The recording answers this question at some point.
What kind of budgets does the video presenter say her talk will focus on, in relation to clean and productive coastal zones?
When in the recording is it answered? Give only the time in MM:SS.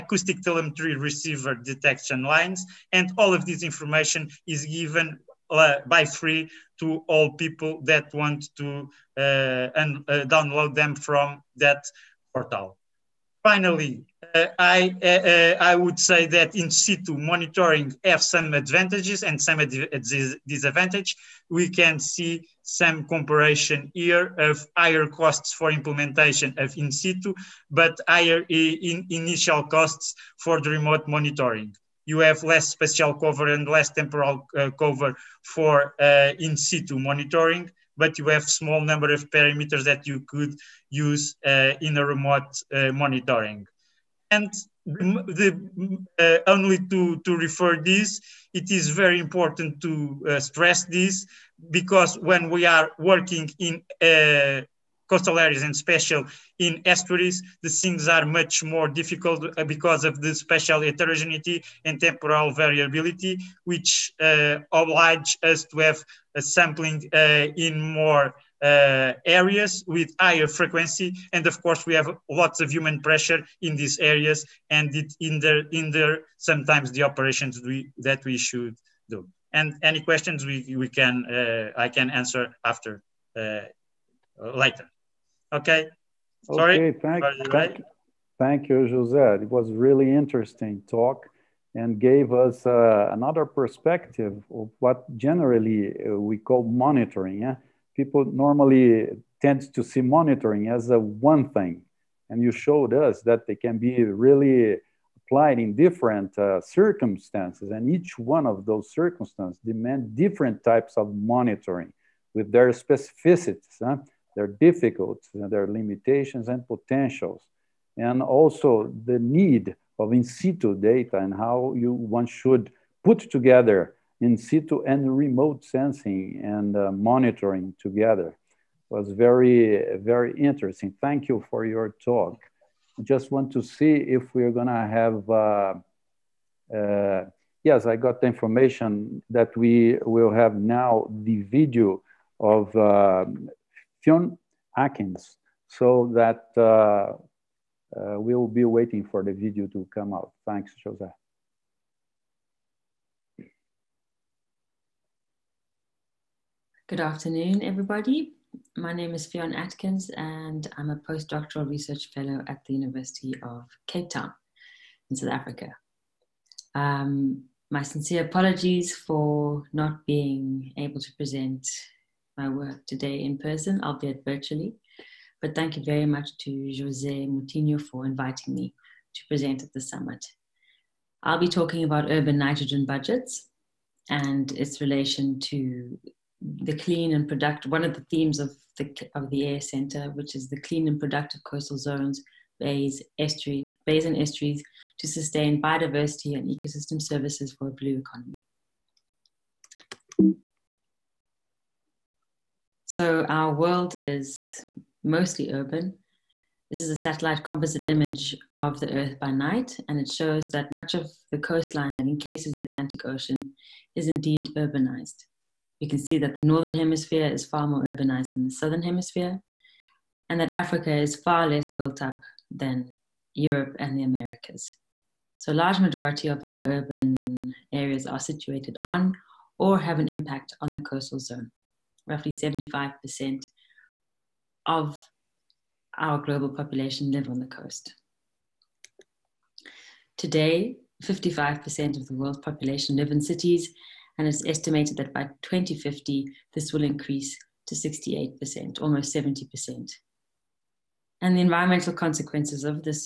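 03:02.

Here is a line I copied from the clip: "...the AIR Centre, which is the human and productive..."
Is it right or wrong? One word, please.
wrong.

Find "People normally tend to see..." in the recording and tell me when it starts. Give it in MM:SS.
01:37.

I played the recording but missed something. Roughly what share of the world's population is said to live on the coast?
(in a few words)
75%.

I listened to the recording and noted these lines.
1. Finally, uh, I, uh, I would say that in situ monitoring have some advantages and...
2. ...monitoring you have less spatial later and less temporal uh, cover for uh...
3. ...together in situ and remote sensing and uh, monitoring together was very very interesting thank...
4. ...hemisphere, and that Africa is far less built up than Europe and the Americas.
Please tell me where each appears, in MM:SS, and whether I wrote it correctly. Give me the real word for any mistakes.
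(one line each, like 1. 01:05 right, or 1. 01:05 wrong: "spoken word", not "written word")
1. 00:13 right
2. 00:31 wrong: "cover", not "later"
3. 02:03 right
4. 03:38 right.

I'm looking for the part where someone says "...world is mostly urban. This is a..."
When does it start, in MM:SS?
03:23.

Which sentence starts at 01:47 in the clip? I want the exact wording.
And each one of those circumstances demand different types of monitoring with their specificities.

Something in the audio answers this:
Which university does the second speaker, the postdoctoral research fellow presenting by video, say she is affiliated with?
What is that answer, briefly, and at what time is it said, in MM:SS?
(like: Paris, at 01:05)
University of Cape Town, at 02:42.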